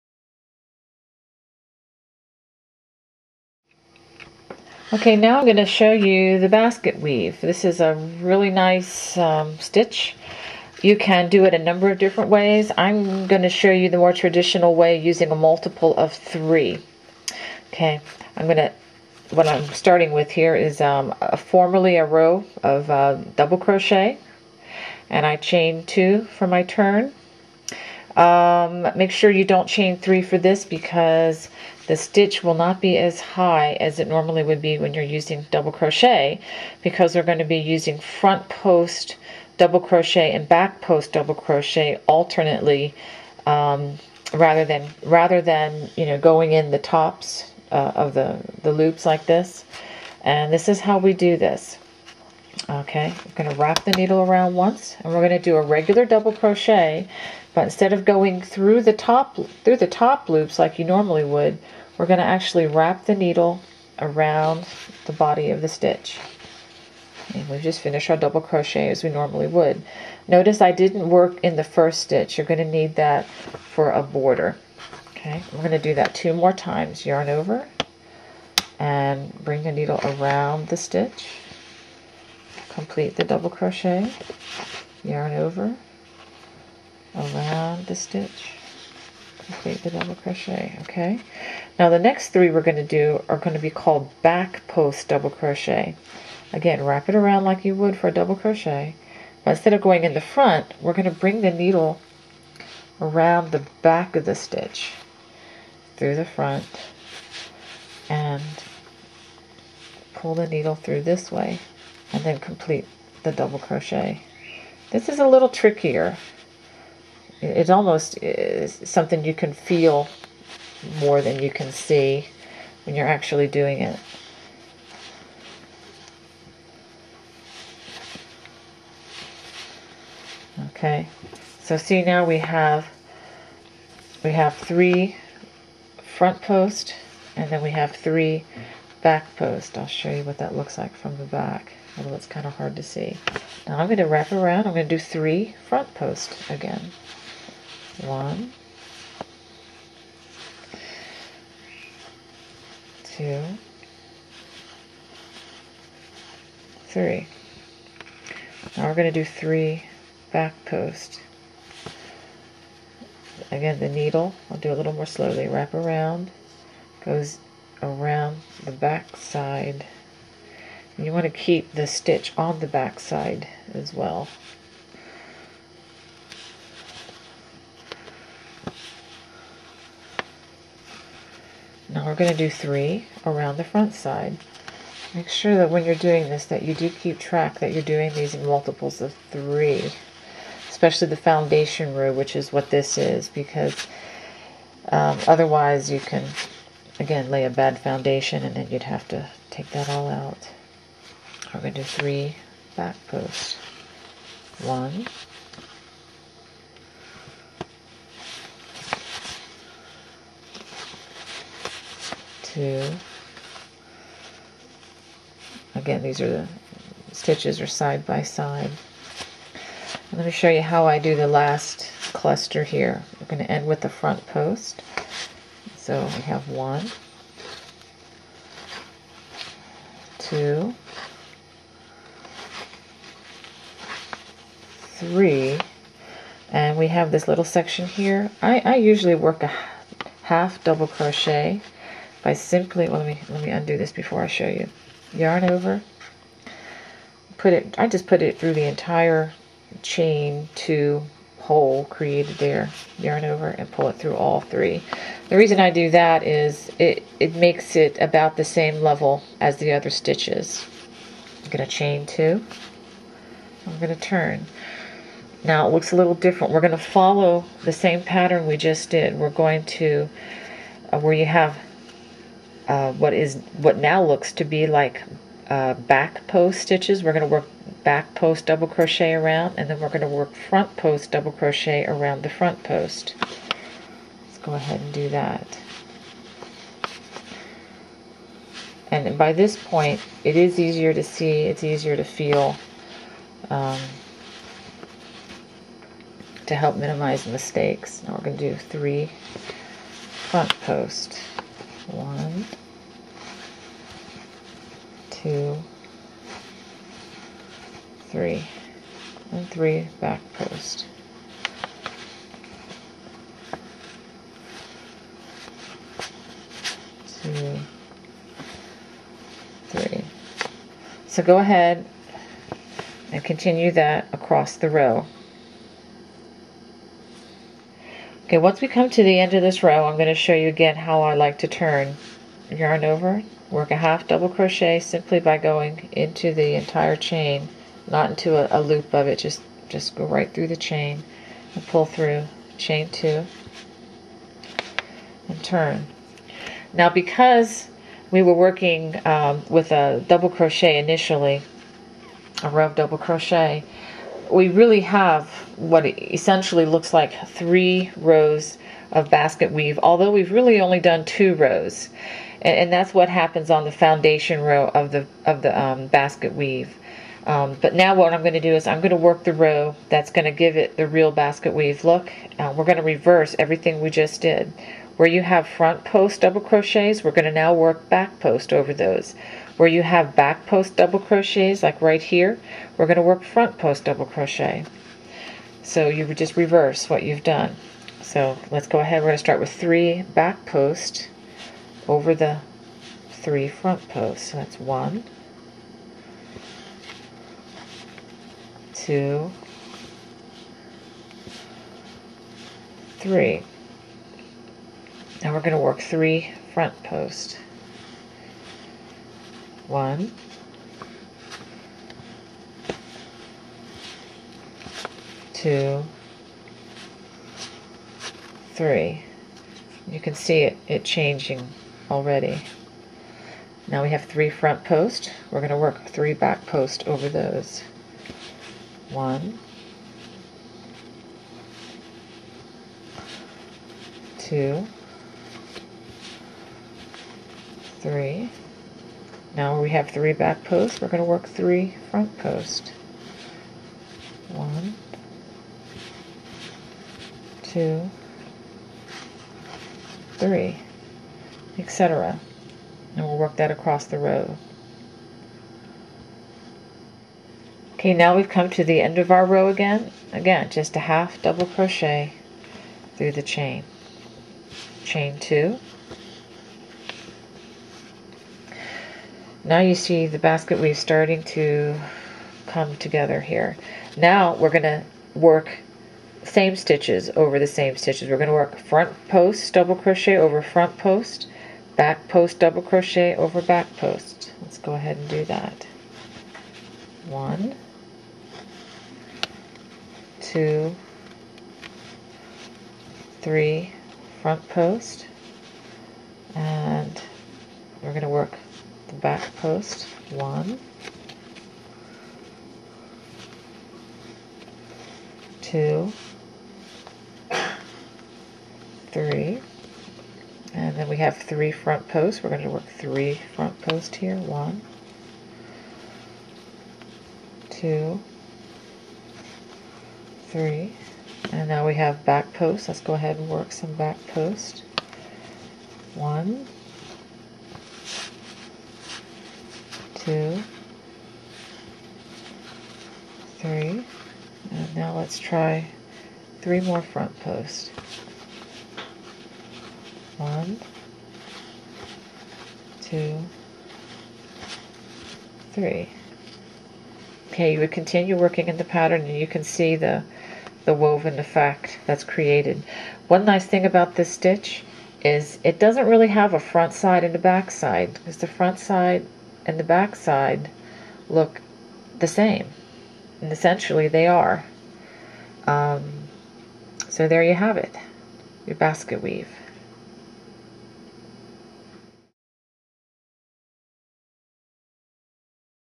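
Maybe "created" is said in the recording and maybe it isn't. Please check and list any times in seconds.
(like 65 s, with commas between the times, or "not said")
251 s, 552 s.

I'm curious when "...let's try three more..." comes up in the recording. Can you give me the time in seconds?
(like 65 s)
534 s.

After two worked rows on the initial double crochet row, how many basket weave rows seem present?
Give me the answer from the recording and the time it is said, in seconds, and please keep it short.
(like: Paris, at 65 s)
3, at 357 s.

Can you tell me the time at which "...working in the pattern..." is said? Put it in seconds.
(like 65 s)
548 s.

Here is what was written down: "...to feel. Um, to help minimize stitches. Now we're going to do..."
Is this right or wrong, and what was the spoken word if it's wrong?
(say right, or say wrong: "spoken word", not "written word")
wrong: "mistakes", not "stitches".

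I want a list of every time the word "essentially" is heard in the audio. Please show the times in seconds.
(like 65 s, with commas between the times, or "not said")
355 s, 563 s.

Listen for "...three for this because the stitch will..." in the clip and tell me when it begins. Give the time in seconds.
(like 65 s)
29 s.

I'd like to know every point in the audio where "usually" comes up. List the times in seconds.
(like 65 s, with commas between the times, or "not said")
238 s.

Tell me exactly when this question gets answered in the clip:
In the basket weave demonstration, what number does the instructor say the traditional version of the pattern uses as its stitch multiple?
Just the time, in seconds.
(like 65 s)
15 s.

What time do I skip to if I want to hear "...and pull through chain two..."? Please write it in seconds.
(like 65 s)
341 s.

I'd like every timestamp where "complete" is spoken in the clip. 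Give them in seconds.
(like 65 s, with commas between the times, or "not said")
82 s, 89 s, 112 s.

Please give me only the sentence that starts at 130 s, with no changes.
Okay, so see now we have we have three front post and then we have three back post.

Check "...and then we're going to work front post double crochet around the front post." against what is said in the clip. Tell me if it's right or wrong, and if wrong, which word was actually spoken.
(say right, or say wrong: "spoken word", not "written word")
right.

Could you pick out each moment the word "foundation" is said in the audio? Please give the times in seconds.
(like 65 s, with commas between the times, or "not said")
191 s, 197 s, 363 s.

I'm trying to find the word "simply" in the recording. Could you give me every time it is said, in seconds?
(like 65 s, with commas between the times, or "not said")
242 s, 334 s.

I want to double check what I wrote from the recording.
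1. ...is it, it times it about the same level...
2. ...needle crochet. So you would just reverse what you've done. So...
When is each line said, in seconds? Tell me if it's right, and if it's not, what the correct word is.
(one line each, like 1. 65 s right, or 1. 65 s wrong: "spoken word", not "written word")
1. 256 s wrong: "makes", not "times"
2. 383 s wrong: "double", not "needle".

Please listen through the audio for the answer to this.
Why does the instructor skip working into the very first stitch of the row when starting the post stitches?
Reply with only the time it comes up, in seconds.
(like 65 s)
72 s.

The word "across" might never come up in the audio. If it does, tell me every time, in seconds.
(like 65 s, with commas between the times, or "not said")
324 s, 453 s.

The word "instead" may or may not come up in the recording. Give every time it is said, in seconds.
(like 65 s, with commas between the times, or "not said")
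57 s, 99 s.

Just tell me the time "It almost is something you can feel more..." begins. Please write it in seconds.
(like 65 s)
117 s.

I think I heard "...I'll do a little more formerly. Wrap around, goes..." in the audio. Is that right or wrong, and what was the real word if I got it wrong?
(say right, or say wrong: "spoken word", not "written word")
wrong: "slowly", not "formerly".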